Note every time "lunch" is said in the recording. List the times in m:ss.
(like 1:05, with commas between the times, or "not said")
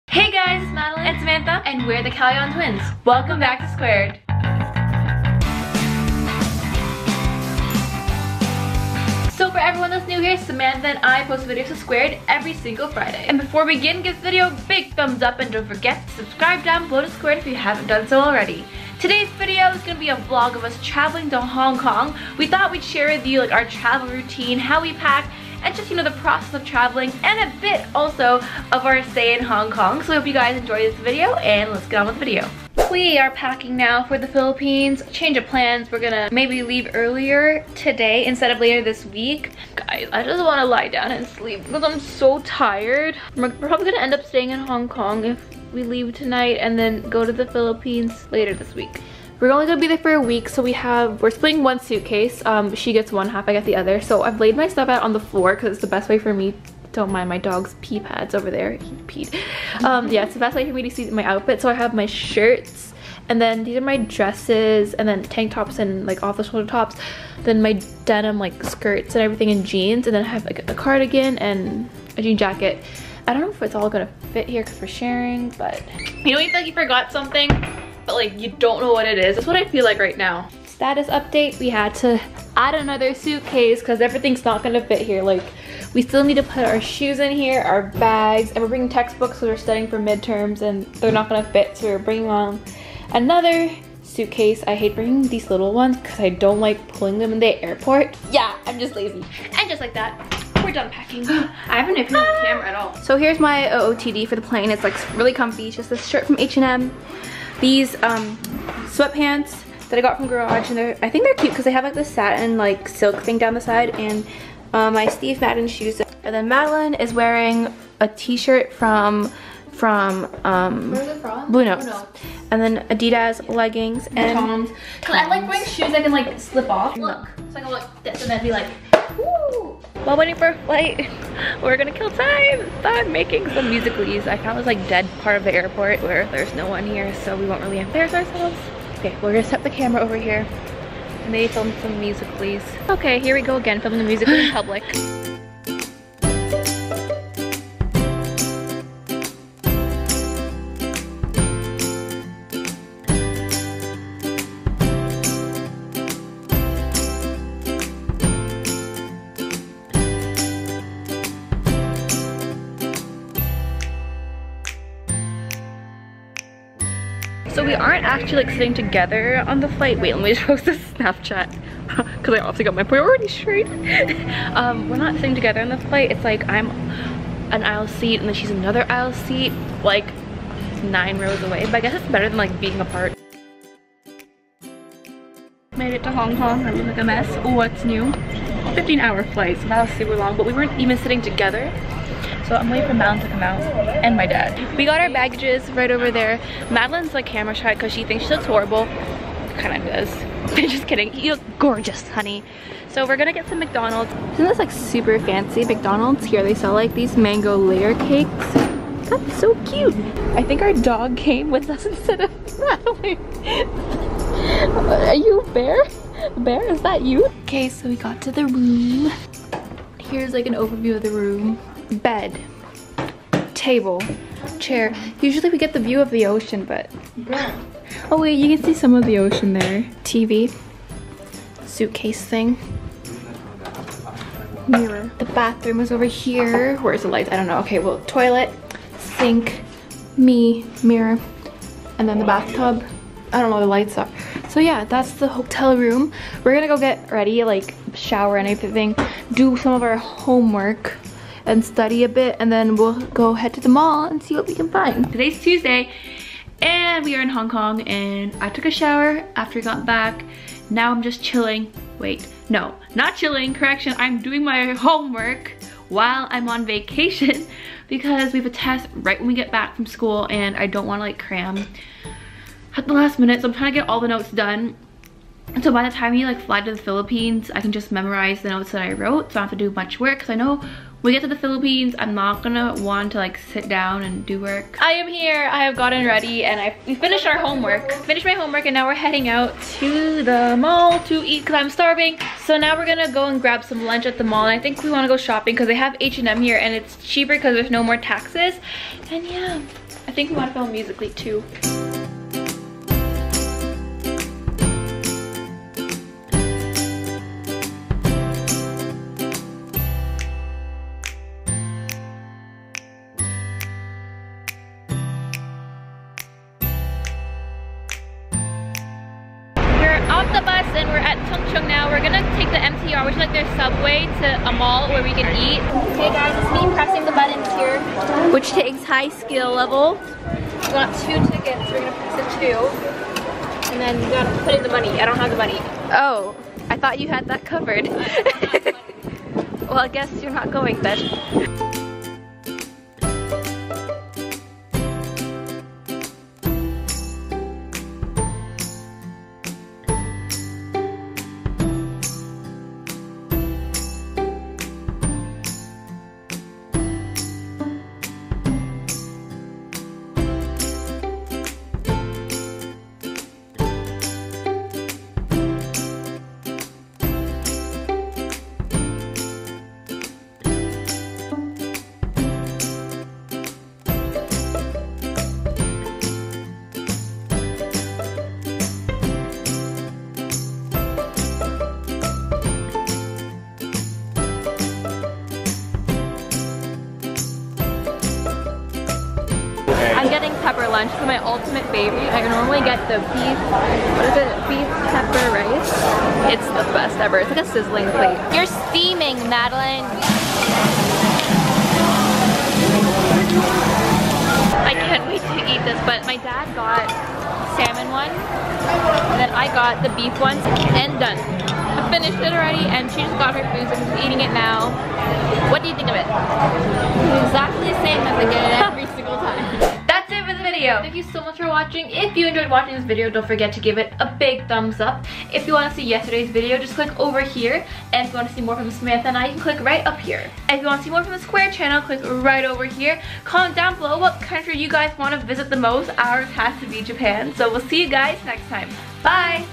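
4:53, 6:30.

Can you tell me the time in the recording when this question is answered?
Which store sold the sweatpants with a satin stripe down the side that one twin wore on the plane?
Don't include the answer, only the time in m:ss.
1:50.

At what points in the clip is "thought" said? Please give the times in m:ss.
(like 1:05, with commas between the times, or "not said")
0:22, 5:36.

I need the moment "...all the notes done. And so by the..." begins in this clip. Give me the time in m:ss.
4:33.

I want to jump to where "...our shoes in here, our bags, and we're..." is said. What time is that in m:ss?
1:26.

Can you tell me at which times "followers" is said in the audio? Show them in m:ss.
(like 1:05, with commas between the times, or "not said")
not said.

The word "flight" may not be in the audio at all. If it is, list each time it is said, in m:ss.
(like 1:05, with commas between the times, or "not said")
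2:10, 2:49, 2:55, 3:09.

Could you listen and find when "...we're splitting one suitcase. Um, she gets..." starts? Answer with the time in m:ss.
0:51.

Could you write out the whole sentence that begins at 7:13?
Comment down below what country you guys want to visit the most.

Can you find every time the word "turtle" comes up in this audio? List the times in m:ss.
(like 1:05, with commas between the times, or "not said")
not said.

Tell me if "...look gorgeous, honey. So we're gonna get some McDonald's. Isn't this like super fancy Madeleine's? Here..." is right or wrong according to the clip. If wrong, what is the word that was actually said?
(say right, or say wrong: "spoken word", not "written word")
wrong: "McDonald", not "Madeleine".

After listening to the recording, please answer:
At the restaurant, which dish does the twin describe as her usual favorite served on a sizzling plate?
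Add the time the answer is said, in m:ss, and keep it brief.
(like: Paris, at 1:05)
beef pepper rice, at 6:34.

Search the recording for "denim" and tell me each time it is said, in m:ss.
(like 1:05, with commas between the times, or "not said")
1:08.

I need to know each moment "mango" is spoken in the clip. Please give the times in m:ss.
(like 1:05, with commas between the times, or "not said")
3:27.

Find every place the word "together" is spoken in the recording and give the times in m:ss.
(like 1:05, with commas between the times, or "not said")
2:48, 2:55, 3:11.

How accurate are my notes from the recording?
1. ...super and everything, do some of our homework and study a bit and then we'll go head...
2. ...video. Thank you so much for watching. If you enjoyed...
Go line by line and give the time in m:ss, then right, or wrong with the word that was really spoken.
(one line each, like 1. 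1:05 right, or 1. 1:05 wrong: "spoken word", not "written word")
1. 4:07 wrong: "shower", not "super"
2. 7:00 right.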